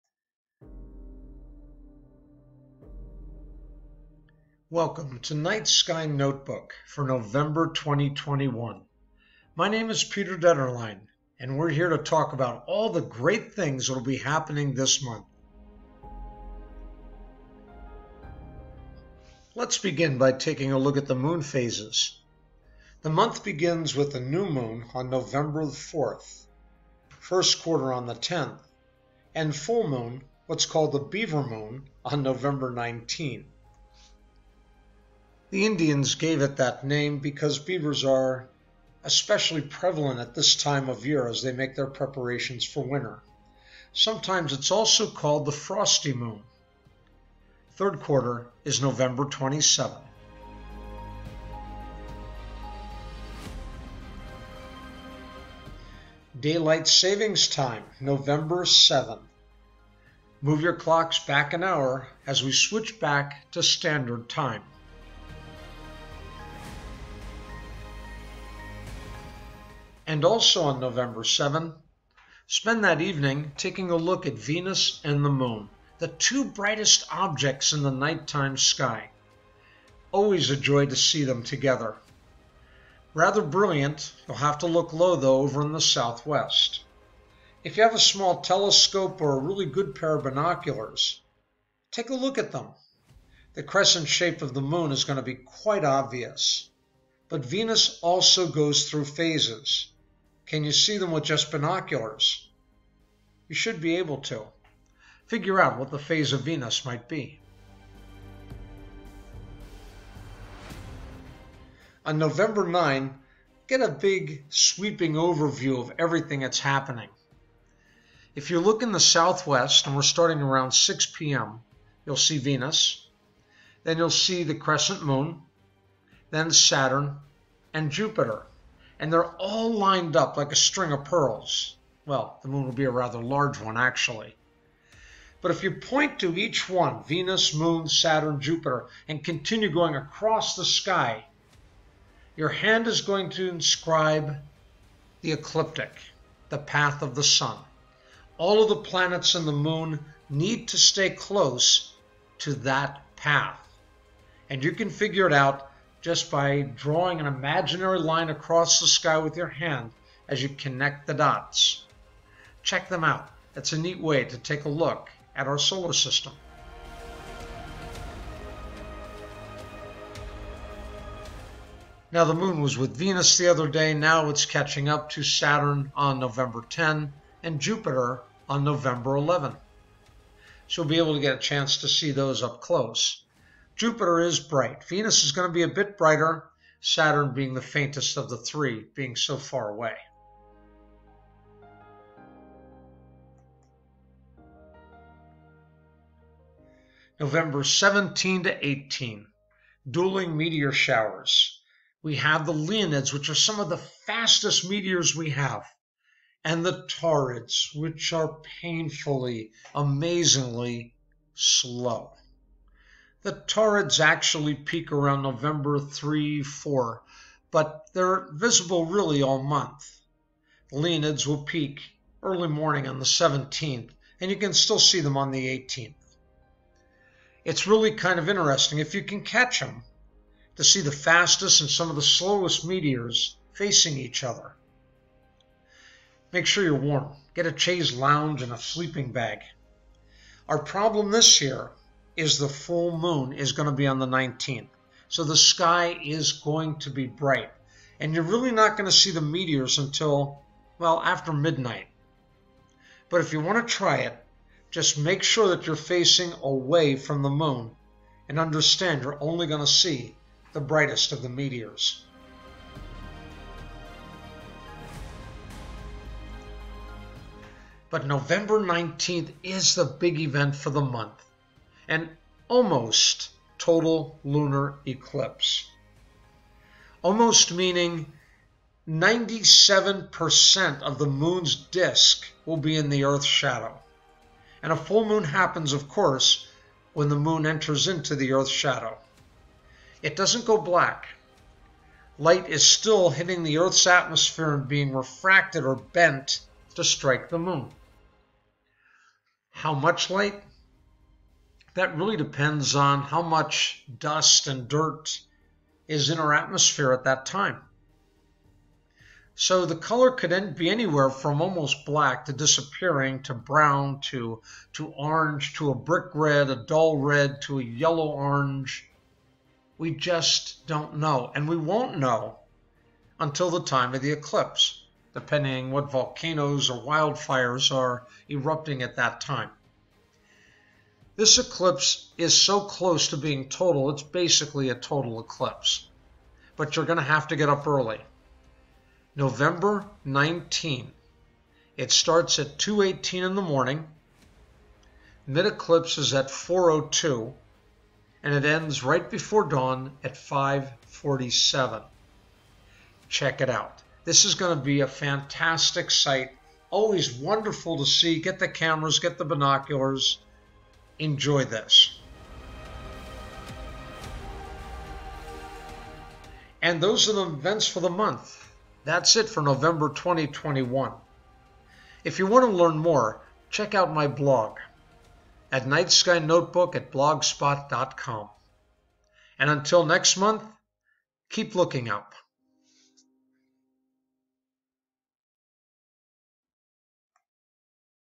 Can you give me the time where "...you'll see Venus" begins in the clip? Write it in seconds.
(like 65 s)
122 s.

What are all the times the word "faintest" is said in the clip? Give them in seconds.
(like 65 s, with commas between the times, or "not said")
187 s.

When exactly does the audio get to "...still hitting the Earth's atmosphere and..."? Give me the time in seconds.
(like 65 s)
292 s.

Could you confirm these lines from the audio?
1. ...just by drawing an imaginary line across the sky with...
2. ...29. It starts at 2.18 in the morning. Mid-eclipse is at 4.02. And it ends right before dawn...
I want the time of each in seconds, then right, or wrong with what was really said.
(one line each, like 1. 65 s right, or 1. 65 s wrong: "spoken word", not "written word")
1. 156 s right
2. 340 s wrong: "19", not "29".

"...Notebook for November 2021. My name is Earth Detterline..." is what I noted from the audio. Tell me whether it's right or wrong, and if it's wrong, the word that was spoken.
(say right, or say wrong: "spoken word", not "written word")
wrong: "Peter", not "Earth".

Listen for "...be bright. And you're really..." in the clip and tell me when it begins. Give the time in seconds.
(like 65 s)
246 s.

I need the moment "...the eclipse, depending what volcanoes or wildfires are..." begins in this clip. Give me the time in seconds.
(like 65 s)
324 s.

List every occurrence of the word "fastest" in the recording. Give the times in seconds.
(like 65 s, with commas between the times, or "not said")
203 s, 230 s.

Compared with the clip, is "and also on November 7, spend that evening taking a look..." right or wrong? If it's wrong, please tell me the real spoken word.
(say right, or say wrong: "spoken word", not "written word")
right.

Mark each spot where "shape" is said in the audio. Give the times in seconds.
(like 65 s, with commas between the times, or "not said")
94 s.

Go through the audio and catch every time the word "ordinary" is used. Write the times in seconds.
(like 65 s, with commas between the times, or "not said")
not said.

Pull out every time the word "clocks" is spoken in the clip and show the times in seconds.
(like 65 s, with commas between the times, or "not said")
60 s.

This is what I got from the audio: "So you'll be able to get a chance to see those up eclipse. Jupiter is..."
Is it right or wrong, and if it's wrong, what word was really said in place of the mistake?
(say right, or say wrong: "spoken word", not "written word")
wrong: "close", not "eclipse".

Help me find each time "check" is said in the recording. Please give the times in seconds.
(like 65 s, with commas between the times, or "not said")
162 s, 353 s, 373 s.